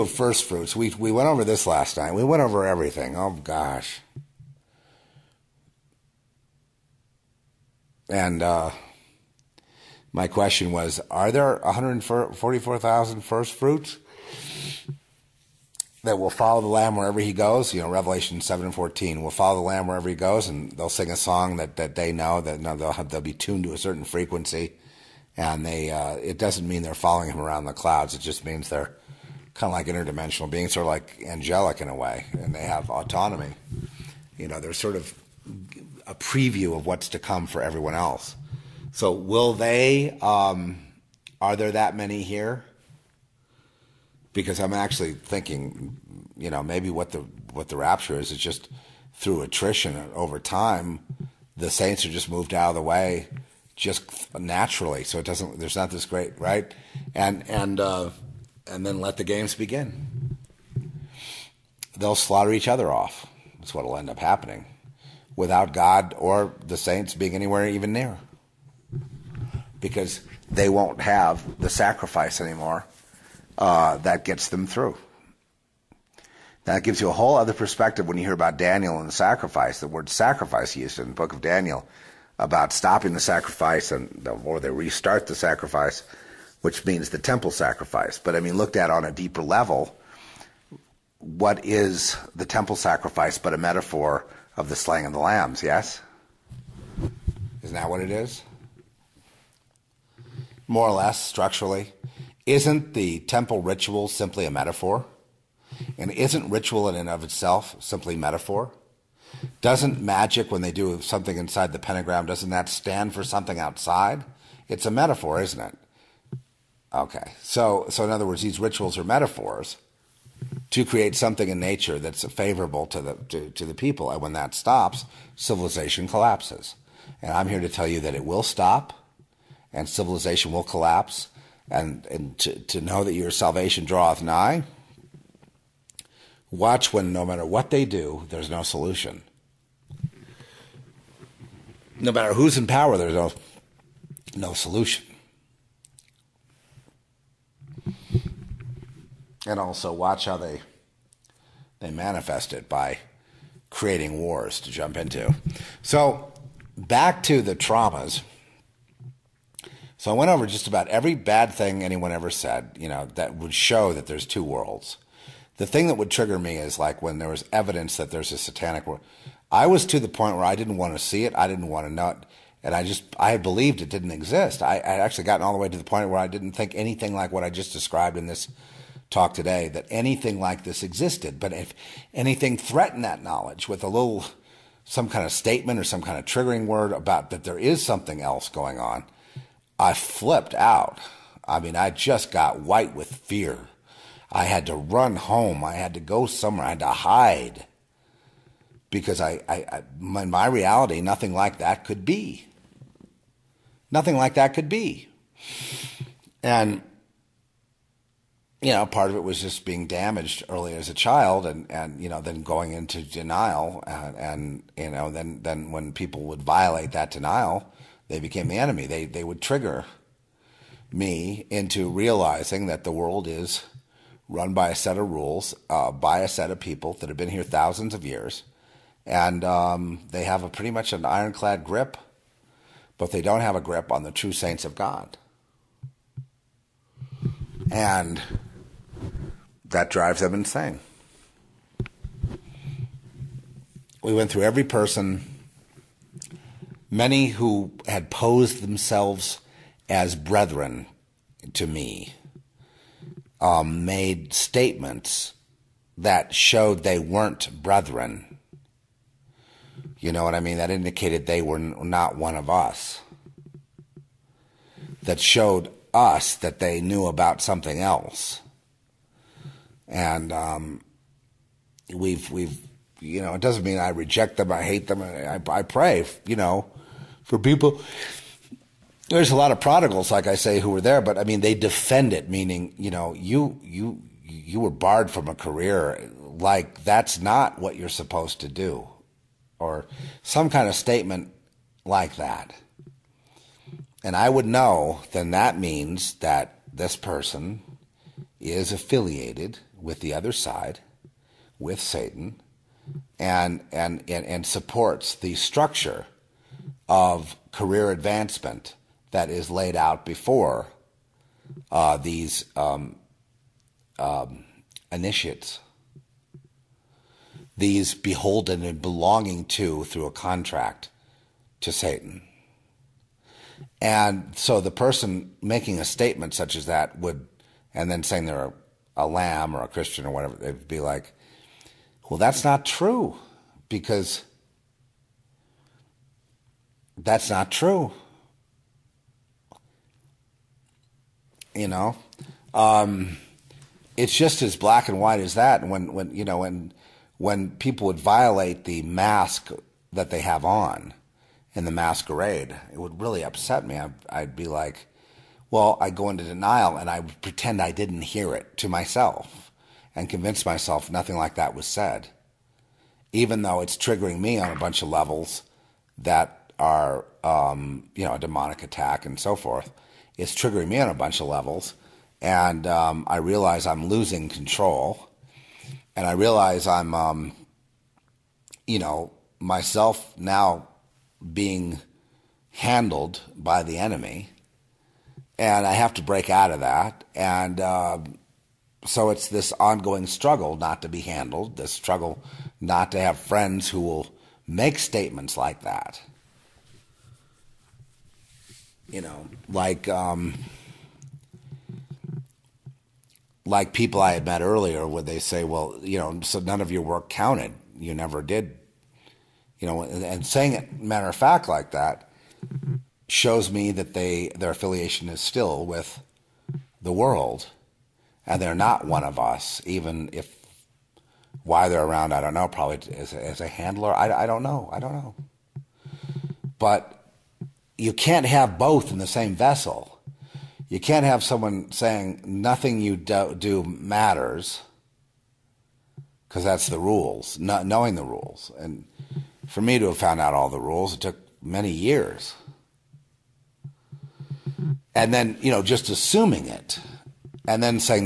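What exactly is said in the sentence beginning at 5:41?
You know, um, it's just as black and white as that.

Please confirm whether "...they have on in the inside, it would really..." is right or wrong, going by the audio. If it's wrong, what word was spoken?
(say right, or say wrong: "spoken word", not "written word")
wrong: "masquerade", not "inside".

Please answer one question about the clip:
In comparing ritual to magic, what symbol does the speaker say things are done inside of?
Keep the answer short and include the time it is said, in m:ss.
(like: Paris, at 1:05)
Pentagram, at 1:51.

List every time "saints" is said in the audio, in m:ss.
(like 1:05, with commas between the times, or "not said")
0:51, 1:06, 3:54.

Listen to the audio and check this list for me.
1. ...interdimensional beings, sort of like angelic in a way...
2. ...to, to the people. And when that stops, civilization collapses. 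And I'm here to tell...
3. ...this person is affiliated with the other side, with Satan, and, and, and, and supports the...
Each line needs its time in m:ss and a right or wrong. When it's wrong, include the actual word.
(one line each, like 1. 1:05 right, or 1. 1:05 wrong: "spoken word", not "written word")
1. 0:29 right
2. 2:03 right
3. 4:56 right.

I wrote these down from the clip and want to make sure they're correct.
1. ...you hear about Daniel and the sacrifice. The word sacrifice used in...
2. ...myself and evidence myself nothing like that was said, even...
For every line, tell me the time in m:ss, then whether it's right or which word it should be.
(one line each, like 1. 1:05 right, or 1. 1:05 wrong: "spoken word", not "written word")
1. 1:18 right
2. 5:58 wrong: "convince", not "evidence".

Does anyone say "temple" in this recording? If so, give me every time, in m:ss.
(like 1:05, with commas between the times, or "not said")
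1:27, 1:32, 1:43.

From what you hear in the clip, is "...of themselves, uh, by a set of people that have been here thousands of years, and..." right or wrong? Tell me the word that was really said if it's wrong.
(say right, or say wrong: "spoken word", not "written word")
wrong: "rules", not "themselves".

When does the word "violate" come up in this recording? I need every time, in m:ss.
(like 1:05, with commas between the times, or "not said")
3:36, 5:47.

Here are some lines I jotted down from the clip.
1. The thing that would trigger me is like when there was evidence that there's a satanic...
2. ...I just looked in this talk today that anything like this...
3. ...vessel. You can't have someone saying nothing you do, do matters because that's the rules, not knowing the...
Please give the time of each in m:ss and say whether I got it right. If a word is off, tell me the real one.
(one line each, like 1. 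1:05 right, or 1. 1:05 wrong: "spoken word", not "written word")
1. 2:45 right
2. 2:57 wrong: "described", not "looked"
3. 7:09 right.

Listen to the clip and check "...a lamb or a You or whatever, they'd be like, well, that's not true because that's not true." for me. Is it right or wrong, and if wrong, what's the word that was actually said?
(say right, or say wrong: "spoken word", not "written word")
wrong: "Christian", not "You".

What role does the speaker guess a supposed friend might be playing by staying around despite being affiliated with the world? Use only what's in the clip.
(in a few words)
Handler.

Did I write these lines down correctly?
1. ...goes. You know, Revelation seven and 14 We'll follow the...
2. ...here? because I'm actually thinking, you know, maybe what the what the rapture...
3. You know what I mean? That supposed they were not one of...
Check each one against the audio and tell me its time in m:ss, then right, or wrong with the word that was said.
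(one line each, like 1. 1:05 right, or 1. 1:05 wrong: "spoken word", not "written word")
1. 0:17 right
2. 0:42 right
3. 4:19 wrong: "indicated", not "supposed".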